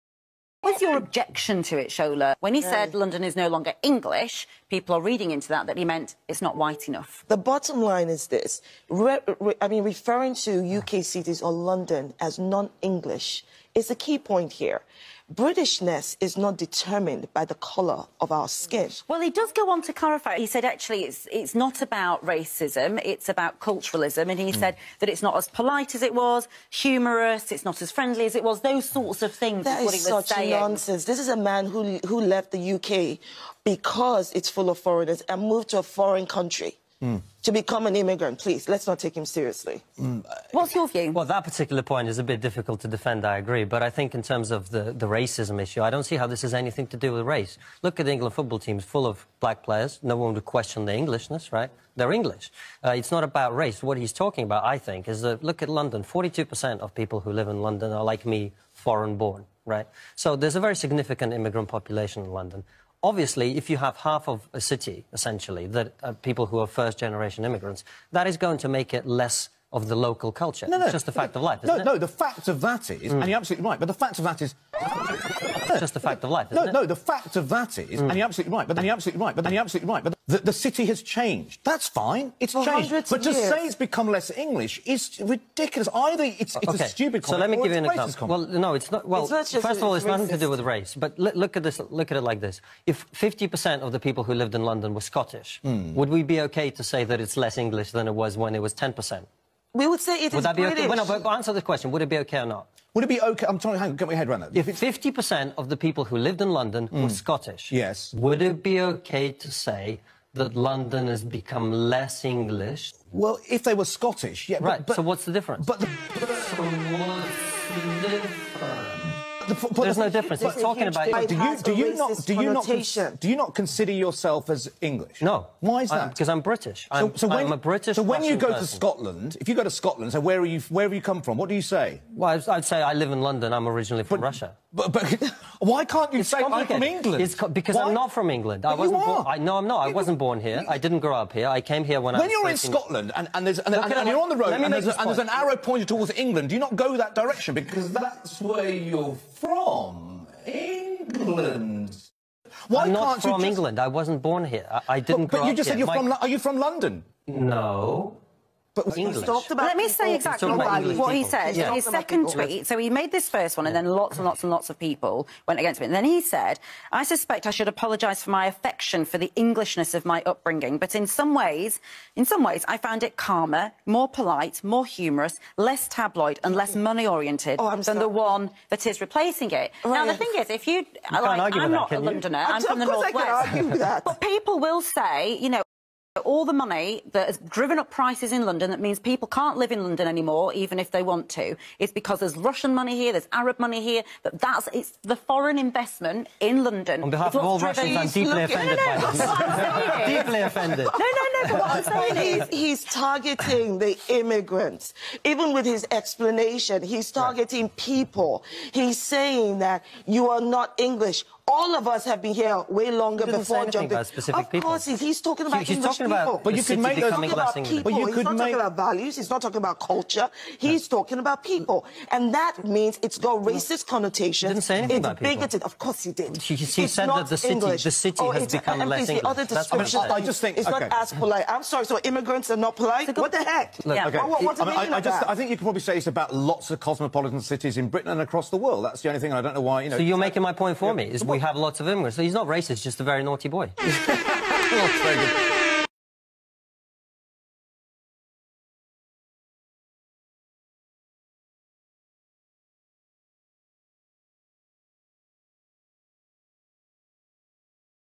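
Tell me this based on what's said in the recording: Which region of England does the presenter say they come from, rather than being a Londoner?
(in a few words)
the North West.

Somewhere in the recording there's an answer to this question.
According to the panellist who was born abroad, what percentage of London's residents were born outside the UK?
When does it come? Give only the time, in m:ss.
0:56.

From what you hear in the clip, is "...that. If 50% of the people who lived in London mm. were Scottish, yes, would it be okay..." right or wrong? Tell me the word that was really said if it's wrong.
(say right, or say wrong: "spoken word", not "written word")
right.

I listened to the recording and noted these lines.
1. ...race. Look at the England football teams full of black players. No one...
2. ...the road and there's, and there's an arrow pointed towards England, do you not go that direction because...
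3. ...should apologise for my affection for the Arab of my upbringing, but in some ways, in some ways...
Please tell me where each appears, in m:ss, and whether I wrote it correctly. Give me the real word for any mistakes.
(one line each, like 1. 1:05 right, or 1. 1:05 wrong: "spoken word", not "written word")
1. 0:47 right
2. 2:24 right
3. 2:47 wrong: "Englishness", not "Arab".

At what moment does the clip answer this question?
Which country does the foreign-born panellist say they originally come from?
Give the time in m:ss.
2:14.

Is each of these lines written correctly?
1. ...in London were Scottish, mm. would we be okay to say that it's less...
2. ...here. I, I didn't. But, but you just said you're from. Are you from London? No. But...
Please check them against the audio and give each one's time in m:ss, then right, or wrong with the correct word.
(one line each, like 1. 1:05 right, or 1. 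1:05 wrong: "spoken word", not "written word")
1. 1:34 right
2. 2:34 right.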